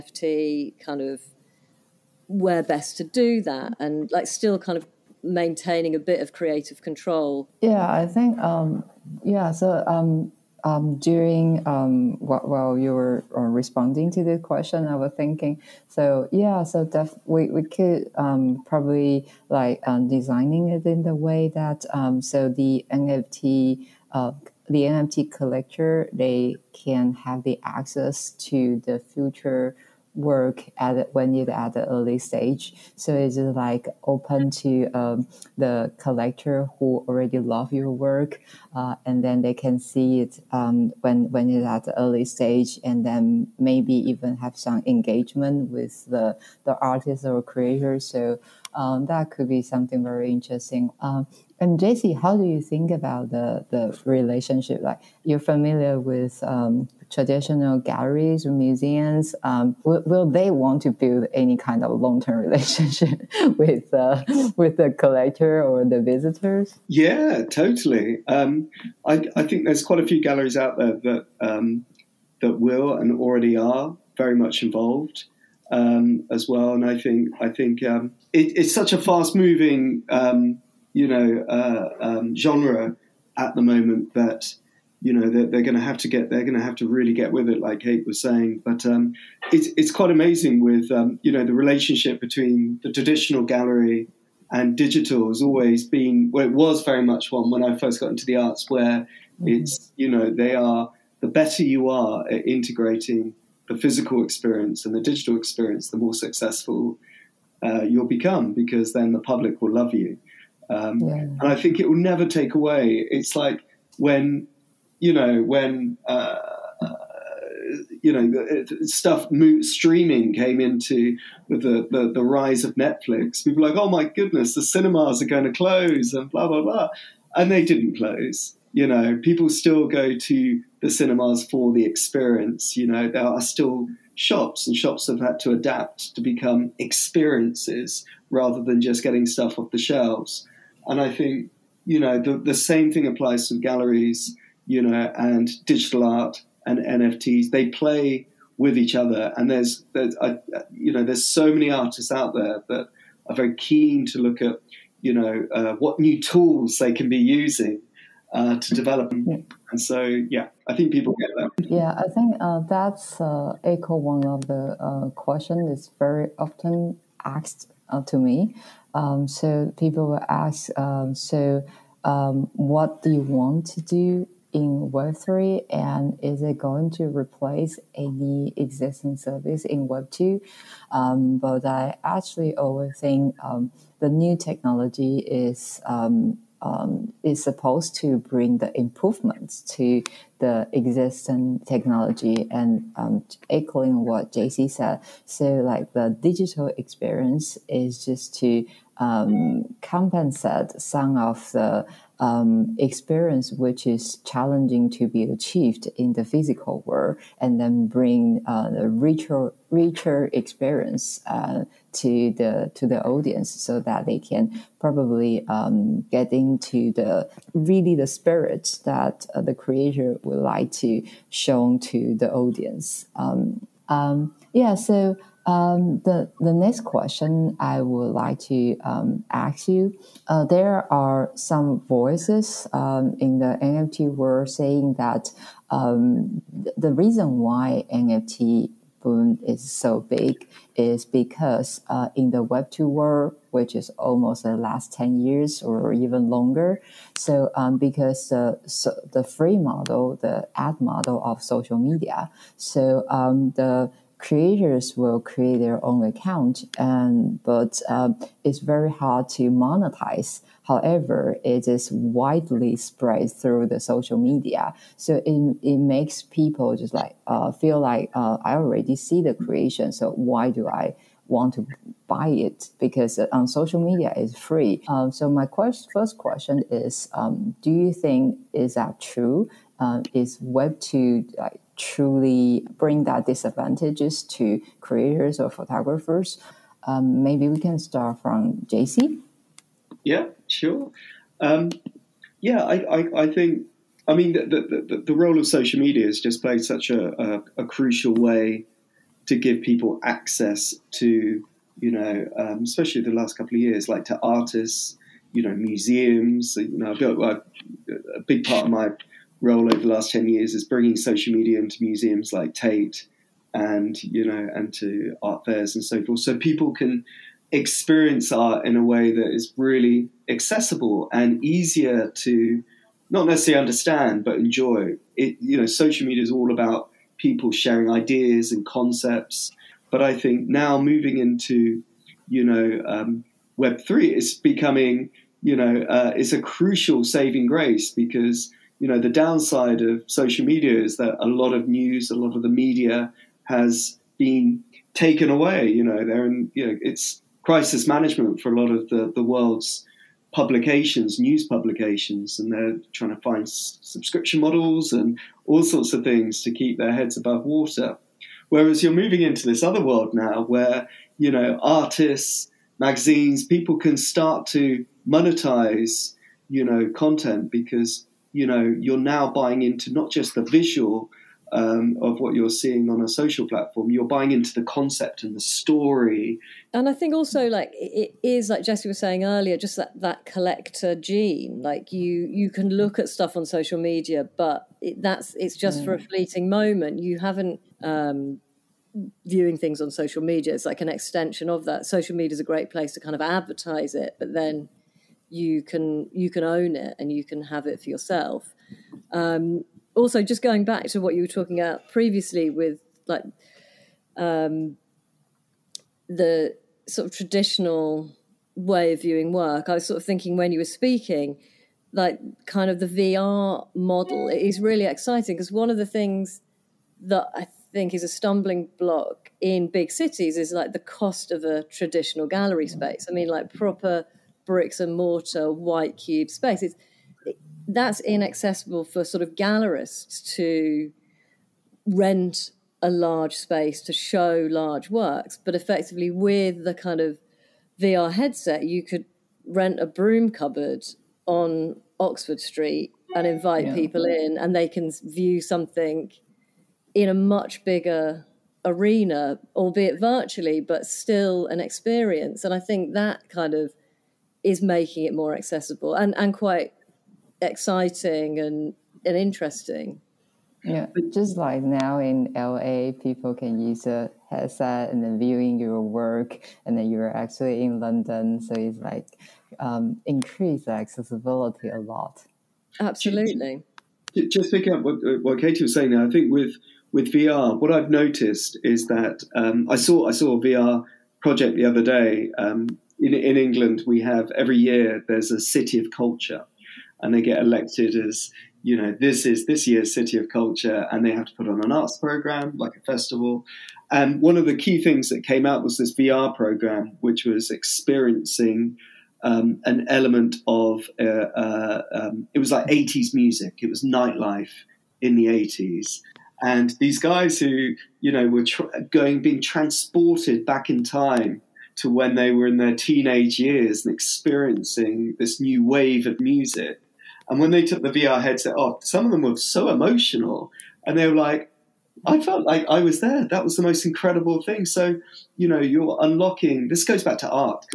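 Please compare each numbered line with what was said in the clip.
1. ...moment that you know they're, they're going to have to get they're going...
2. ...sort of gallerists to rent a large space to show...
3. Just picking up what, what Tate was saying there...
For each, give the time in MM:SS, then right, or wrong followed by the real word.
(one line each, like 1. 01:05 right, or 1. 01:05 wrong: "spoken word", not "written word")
1. 01:23 right
2. 07:09 right
3. 07:54 wrong: "Katie", not "Tate".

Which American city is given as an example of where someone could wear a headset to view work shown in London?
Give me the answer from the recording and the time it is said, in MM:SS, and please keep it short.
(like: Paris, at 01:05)
LA, at 07:42.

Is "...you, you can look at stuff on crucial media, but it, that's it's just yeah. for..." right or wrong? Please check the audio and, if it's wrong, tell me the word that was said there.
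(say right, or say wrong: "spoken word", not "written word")
wrong: "social", not "crucial".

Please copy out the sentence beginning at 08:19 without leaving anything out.
Um, an element of uh, uh, um, it was like 80s music.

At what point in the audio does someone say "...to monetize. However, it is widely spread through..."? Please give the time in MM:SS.
04:19.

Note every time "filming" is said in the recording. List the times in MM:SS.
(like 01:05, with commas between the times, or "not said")
not said.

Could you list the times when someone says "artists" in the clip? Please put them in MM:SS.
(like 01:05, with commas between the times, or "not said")
00:46, 02:31, 05:04, 06:01.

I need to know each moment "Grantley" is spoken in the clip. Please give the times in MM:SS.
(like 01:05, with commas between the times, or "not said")
not said.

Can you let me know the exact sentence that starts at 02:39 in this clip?
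And so, yeah, I think people get that.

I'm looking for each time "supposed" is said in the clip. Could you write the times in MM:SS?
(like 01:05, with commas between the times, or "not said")
03:07.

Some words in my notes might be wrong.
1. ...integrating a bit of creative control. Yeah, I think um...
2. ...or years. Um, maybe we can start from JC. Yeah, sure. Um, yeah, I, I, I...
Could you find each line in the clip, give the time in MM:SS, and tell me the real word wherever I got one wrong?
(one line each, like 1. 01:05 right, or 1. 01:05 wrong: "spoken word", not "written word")
1. 00:05 wrong: "maintaining", not "integrating"
2. 04:45 wrong: "photographers", not "years".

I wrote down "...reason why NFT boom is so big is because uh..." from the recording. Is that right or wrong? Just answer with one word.
right.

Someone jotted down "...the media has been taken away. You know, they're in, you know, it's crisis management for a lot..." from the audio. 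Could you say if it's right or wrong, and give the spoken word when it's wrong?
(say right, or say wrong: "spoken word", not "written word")
right.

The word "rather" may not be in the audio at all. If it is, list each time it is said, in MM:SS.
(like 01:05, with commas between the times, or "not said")
02:18.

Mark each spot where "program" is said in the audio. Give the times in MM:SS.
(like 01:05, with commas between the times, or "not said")
08:11, 08:16.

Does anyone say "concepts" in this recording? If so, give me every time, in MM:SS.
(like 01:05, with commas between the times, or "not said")
05:28, 06:14.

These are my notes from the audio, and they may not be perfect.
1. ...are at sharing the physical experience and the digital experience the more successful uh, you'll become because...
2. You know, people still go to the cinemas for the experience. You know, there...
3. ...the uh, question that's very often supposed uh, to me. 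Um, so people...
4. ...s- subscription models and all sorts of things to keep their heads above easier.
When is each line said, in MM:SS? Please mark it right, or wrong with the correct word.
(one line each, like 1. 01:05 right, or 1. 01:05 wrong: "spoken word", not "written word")
1. 01:41 wrong: "integrating", not "sharing"
2. 02:08 right
3. 02:44 wrong: "asked", not "supposed"
4. 05:53 wrong: "water", not "easier".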